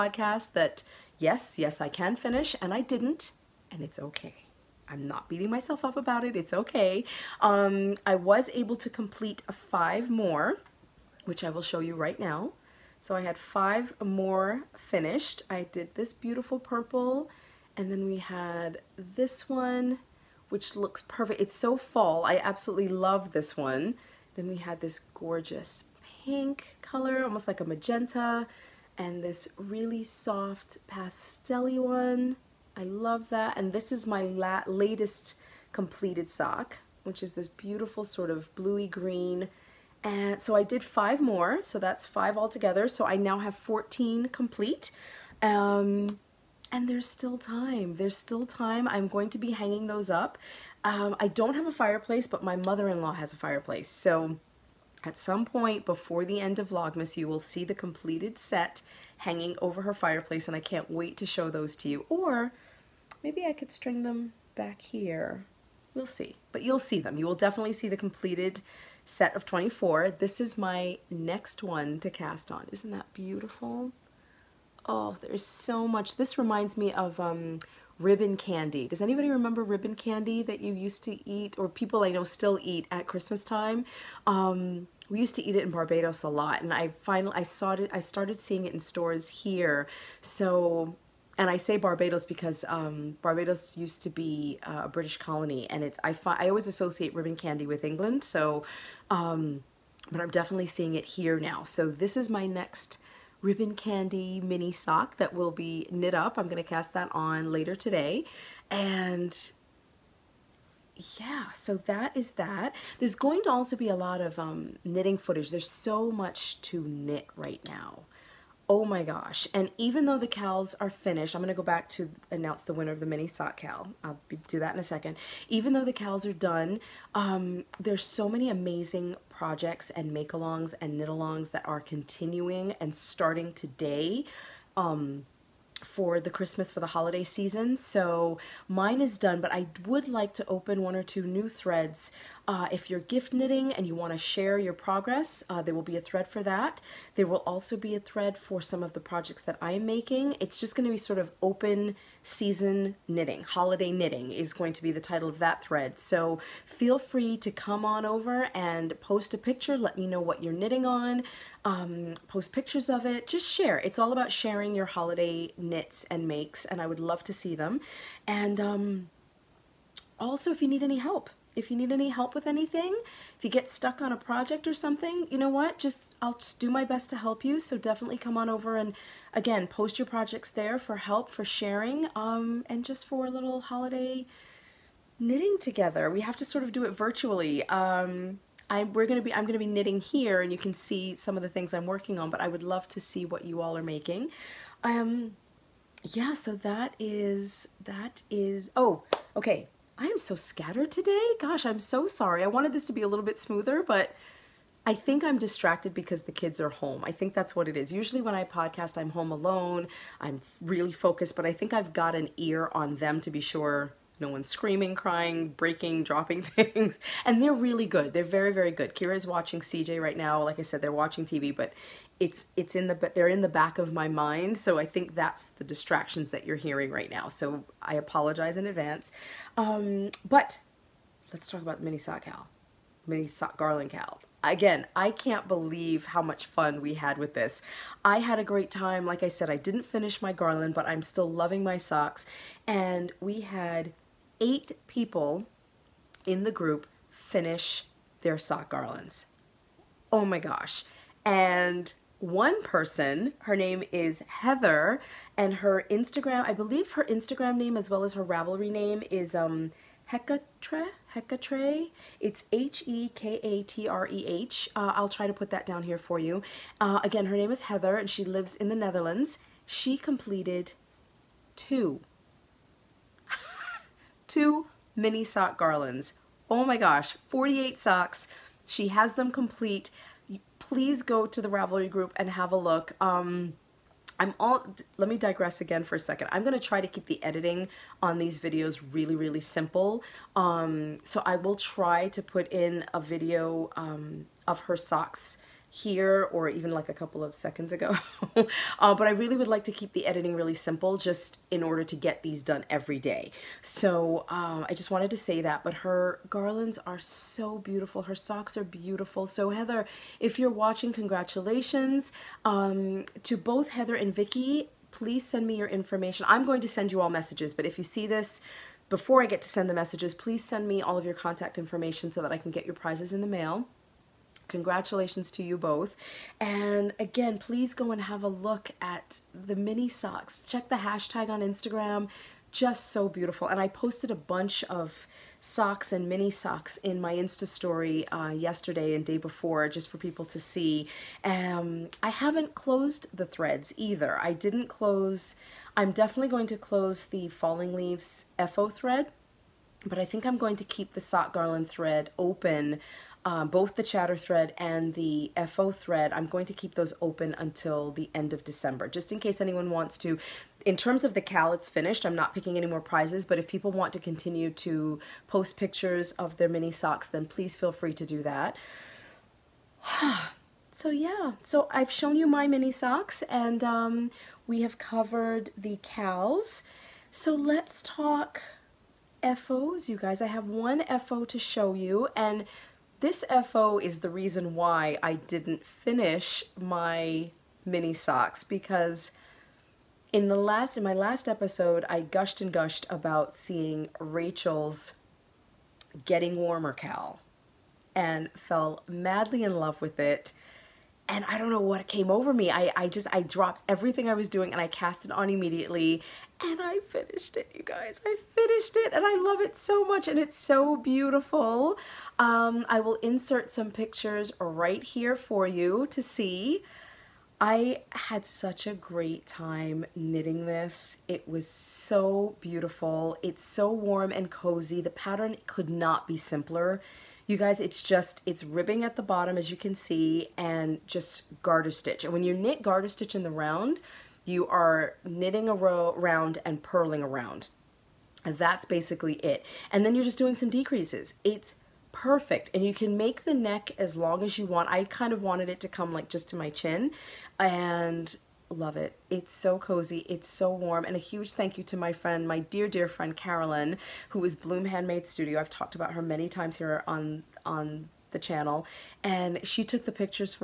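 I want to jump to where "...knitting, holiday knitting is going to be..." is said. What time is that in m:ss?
2:33.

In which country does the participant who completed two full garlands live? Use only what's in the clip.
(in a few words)
the Netherlands.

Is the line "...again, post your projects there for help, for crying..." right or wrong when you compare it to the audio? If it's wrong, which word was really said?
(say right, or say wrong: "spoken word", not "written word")
wrong: "sharing", not "crying".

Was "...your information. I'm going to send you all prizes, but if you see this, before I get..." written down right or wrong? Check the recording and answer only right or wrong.
wrong.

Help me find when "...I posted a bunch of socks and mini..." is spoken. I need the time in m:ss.
5:33.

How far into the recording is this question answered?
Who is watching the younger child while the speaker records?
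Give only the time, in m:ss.
3:38.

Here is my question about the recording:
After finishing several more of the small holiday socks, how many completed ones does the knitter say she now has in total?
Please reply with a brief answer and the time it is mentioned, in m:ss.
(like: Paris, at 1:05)
14, at 0:43.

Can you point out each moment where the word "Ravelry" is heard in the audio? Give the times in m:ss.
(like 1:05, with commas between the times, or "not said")
4:18, 4:41.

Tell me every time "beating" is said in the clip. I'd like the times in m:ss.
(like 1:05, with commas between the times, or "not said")
0:05.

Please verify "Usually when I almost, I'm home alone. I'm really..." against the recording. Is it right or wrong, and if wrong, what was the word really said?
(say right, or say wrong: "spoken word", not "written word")
wrong: "podcast", not "almost".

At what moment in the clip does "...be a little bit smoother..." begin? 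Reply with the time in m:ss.
3:22.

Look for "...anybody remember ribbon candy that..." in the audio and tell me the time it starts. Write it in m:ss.
1:19.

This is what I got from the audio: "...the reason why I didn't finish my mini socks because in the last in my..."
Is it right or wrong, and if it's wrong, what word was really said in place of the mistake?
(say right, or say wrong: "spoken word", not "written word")
right.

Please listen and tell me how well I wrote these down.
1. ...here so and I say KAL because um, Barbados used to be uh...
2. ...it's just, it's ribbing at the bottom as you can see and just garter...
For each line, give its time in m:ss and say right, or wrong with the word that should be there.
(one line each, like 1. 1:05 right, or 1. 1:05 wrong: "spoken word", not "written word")
1. 1:29 wrong: "Barbados", not "KAL"
2. 7:07 right.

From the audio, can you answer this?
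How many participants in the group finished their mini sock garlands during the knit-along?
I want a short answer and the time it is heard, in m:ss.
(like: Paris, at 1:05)
8, at 4:04.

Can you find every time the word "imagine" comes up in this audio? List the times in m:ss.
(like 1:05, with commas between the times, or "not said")
not said.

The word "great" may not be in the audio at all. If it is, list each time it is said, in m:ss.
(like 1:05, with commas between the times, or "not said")
3:58, 6:58.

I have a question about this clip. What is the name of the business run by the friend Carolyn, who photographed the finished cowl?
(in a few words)
Bloom Handmade Studio.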